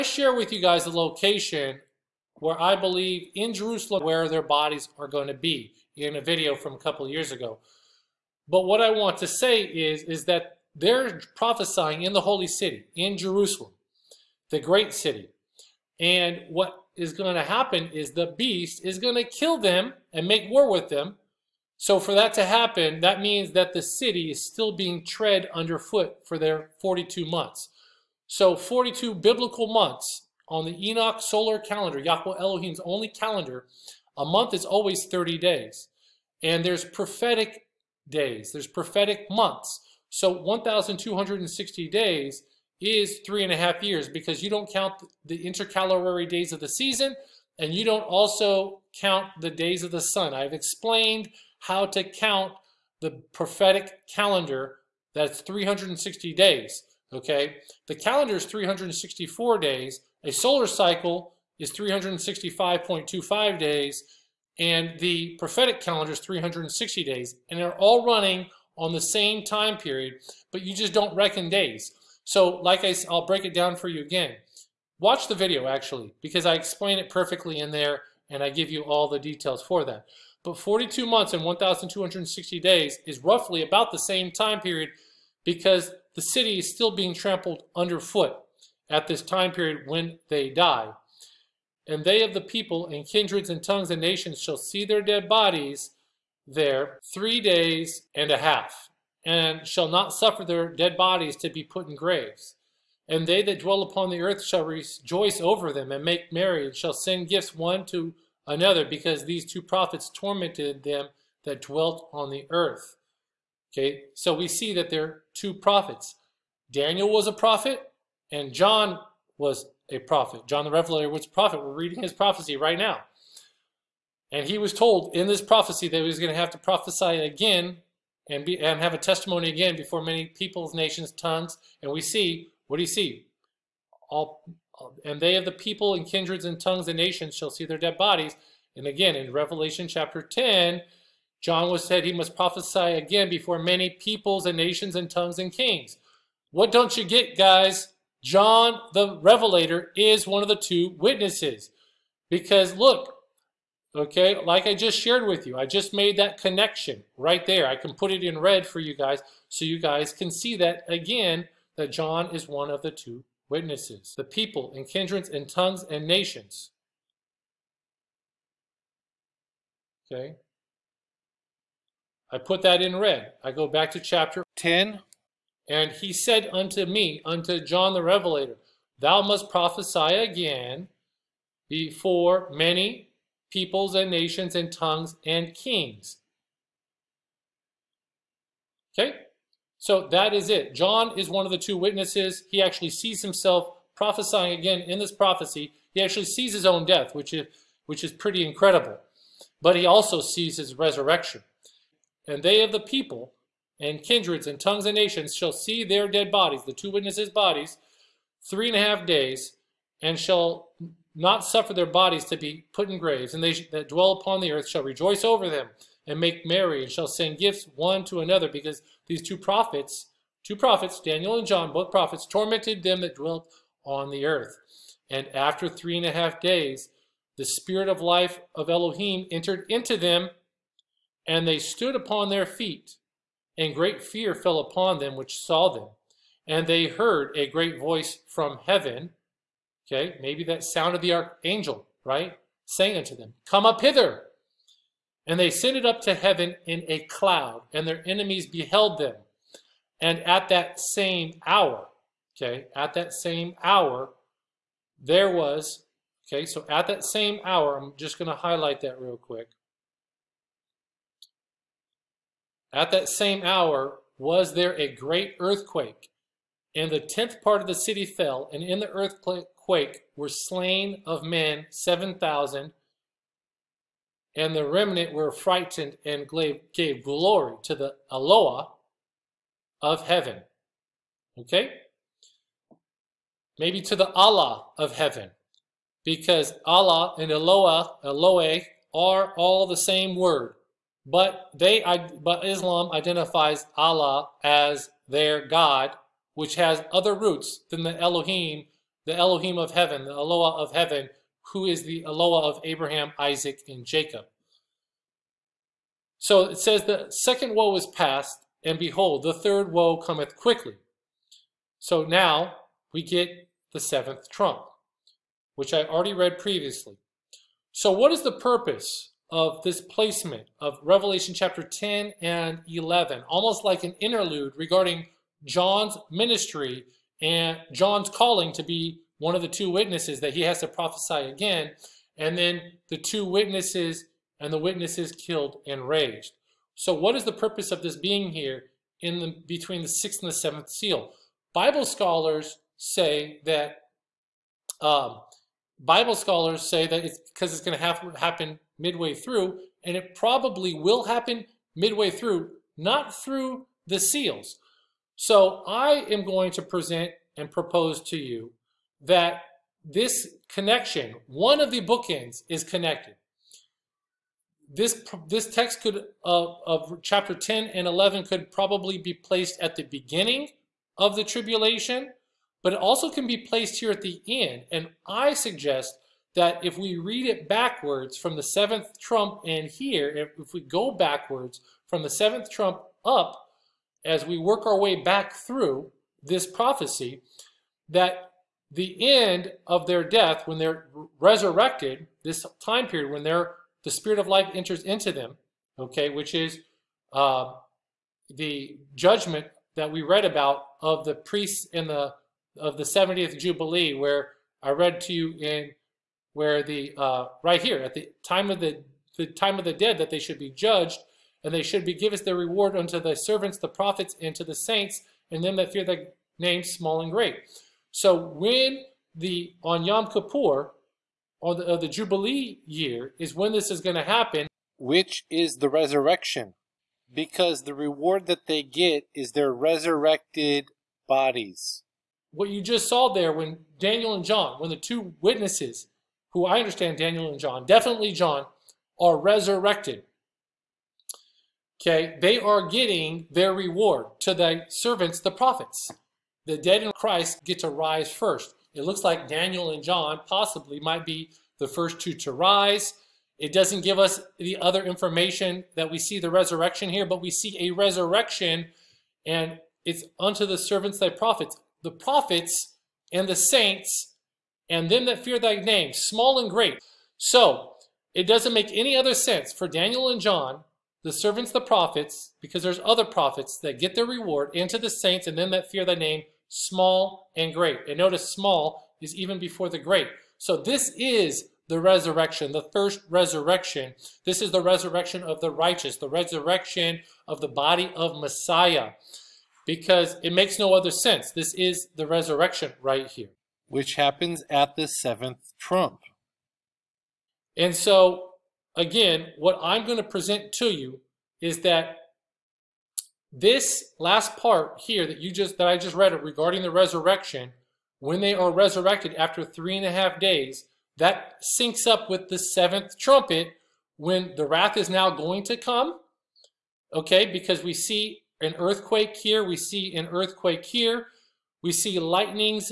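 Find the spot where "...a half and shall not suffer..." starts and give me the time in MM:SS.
01:38.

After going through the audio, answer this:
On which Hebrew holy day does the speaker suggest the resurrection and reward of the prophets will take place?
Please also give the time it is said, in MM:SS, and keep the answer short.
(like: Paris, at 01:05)
Yom Kippur, at 06:59.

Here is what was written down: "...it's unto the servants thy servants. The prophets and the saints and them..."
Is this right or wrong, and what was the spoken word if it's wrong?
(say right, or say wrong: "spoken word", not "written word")
wrong: "prophets", not "servants".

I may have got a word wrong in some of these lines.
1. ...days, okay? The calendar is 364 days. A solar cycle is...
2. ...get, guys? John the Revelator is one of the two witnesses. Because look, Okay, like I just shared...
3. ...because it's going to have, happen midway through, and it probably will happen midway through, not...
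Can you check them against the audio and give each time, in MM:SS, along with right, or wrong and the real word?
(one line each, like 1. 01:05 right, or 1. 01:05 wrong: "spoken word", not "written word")
1. 00:56 right
2. 02:27 right
3. 05:47 right.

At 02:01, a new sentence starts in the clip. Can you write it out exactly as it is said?
We're reading his prophecy right now.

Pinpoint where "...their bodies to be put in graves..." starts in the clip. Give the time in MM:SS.
03:31.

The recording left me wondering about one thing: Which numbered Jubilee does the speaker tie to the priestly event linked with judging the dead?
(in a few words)
70th Jubilee.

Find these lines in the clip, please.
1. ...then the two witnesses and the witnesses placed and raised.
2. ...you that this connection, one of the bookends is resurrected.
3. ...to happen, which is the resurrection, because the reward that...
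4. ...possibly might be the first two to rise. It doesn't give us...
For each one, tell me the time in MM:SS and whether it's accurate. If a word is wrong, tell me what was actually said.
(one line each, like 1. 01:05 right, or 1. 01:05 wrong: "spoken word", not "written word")
1. 05:32 wrong: "killed", not "placed"
2. 05:58 wrong: "connected", not "resurrected"
3. 07:03 right
4. 07:30 right.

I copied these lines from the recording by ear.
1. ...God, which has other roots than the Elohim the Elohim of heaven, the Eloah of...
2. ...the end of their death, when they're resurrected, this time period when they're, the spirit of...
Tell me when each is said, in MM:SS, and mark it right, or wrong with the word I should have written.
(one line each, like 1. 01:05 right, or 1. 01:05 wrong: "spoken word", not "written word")
1. 04:55 right
2. 06:28 right.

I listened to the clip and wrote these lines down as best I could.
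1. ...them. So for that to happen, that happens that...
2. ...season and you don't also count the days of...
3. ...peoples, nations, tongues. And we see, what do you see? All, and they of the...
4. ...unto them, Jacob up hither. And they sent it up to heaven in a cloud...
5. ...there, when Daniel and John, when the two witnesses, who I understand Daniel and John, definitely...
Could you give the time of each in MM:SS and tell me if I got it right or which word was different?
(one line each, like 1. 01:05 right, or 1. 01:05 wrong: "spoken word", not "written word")
1. 00:20 wrong: "means", not "happens"
2. 00:46 right
3. 02:10 right
4. 04:02 wrong: "Come", not "Jacob"
5. 07:13 right.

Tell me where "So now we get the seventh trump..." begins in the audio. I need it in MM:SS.
05:11.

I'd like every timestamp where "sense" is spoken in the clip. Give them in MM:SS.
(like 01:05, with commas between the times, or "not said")
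07:49, 08:10.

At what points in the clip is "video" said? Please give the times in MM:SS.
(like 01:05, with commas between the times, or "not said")
00:06, 01:15.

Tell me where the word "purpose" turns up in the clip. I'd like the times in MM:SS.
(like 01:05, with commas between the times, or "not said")
05:18, 05:37.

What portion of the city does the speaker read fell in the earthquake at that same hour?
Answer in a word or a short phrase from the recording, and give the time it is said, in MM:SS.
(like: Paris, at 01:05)
The tenth part, at 04:26.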